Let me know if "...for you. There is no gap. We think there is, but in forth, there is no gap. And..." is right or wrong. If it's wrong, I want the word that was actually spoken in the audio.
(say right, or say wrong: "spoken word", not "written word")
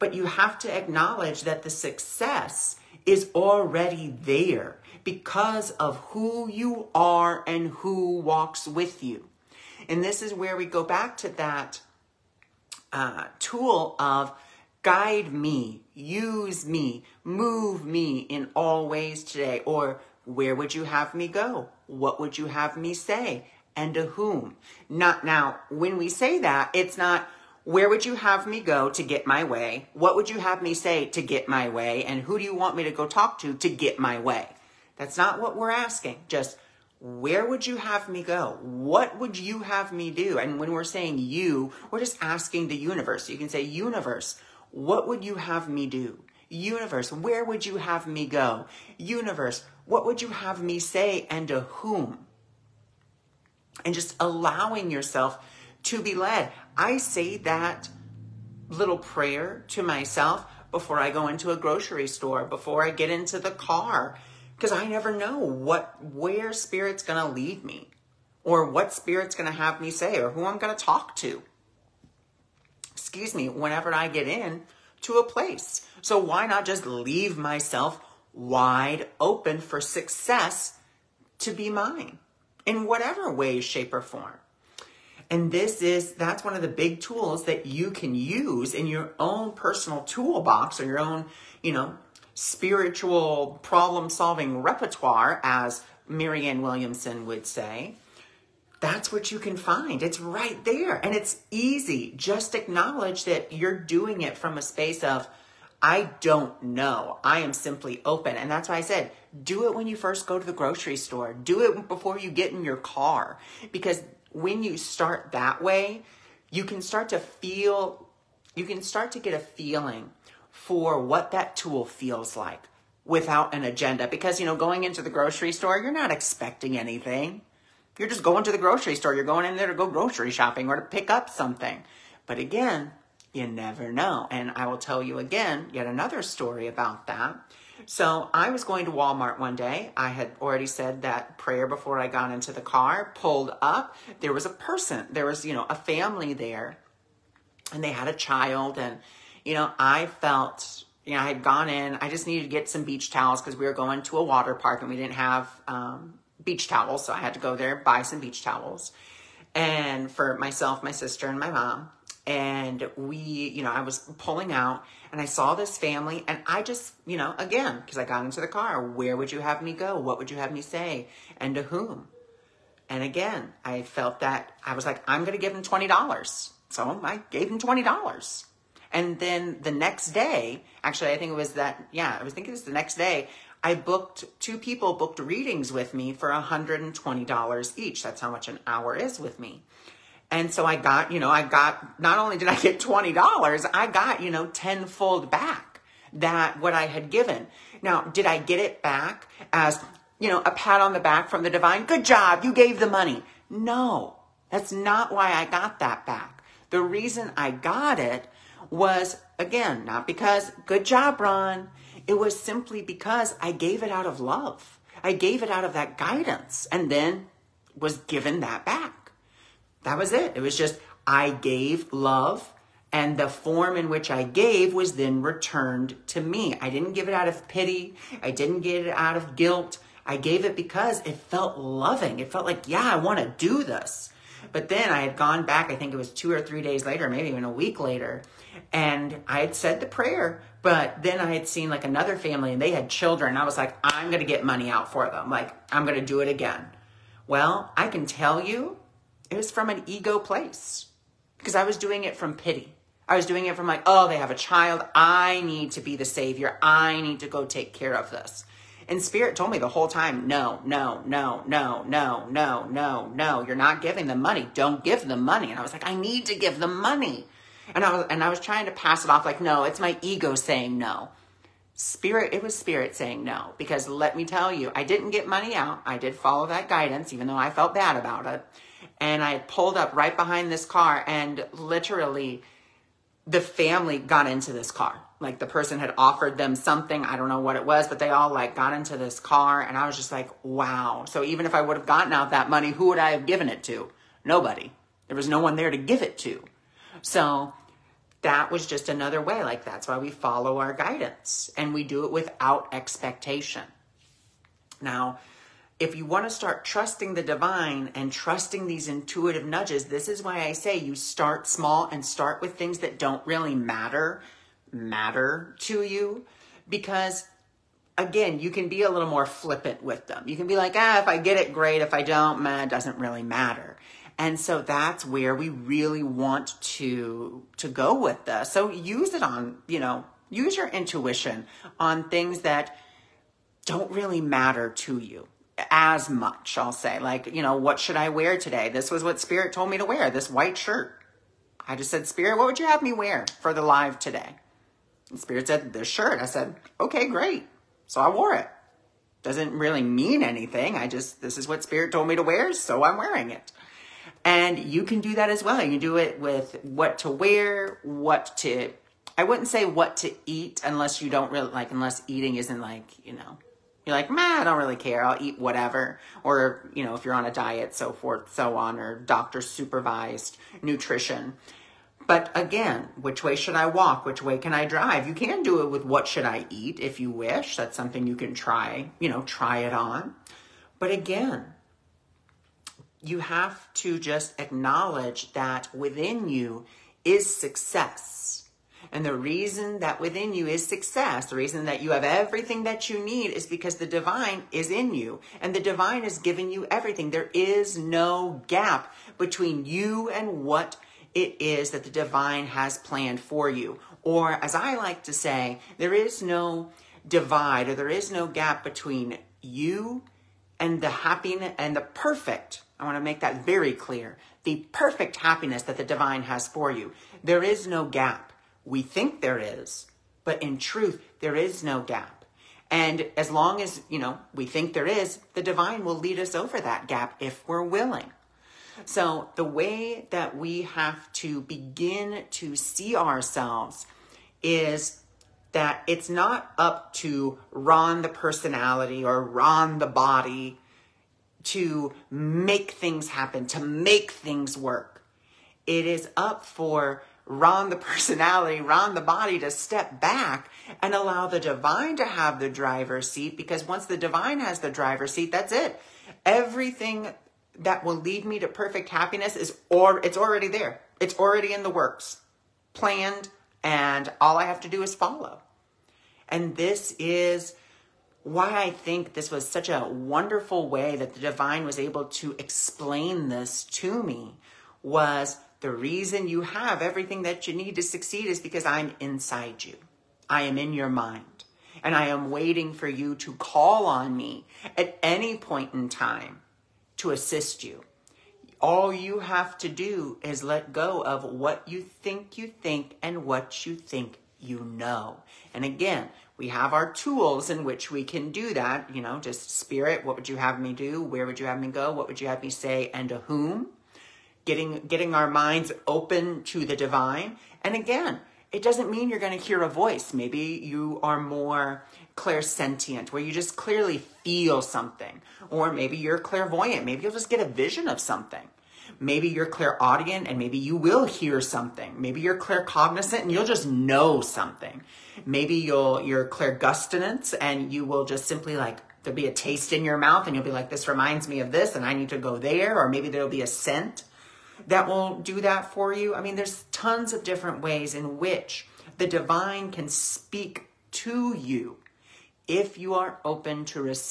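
wrong: "truth", not "forth".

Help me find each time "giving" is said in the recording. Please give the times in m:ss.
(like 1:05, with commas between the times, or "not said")
4:23, 6:36.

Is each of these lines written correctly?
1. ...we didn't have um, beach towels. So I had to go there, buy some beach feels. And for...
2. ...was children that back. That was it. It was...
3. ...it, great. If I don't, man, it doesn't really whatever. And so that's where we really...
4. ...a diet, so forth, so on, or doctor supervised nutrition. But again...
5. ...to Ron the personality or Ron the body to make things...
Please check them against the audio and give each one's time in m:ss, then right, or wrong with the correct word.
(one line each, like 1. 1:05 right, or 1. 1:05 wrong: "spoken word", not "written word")
1. 2:34 wrong: "towels", not "feels"
2. 3:37 wrong: "given", not "children"
3. 5:21 wrong: "matter", not "whatever"
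4. 6:07 right
5. 7:16 right.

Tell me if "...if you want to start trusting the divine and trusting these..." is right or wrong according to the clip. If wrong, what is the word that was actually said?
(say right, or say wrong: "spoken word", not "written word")
right.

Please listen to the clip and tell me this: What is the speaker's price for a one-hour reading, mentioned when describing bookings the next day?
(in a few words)
$120.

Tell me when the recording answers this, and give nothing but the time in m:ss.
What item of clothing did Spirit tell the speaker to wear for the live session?
5:40.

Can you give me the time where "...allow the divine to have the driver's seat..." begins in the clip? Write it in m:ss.
7:30.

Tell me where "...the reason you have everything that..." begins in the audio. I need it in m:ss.
7:55.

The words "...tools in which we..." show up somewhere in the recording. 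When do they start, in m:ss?
8:16.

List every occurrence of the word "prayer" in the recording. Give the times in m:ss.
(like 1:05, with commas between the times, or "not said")
0:58, 2:21, 3:59.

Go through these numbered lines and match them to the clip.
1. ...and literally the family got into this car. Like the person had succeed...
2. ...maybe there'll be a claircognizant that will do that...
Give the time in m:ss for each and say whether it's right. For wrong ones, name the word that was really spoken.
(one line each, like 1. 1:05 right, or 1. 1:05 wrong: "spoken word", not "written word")
1. 4:41 wrong: "offered", not "succeed"
2. 8:52 wrong: "scent", not "claircognizant".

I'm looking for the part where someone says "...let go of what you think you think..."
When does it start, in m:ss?
8:10.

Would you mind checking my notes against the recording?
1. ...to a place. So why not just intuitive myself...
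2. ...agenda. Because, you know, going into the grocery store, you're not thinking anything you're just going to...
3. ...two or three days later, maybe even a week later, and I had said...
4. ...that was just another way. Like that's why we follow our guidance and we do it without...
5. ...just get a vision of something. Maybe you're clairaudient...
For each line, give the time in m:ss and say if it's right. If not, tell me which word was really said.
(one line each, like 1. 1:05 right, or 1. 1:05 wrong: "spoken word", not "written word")
1. 1:15 wrong: "leave", not "intuitive"
2. 2:03 wrong: "expecting", not "thinking"
3. 3:56 right
4. 4:58 right
5. 8:37 right.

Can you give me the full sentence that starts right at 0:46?
Universe, where would you have me go?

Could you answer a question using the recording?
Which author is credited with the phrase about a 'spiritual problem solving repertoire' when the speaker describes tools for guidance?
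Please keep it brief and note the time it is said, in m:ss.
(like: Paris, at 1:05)
Marianne Williamson, at 1:36.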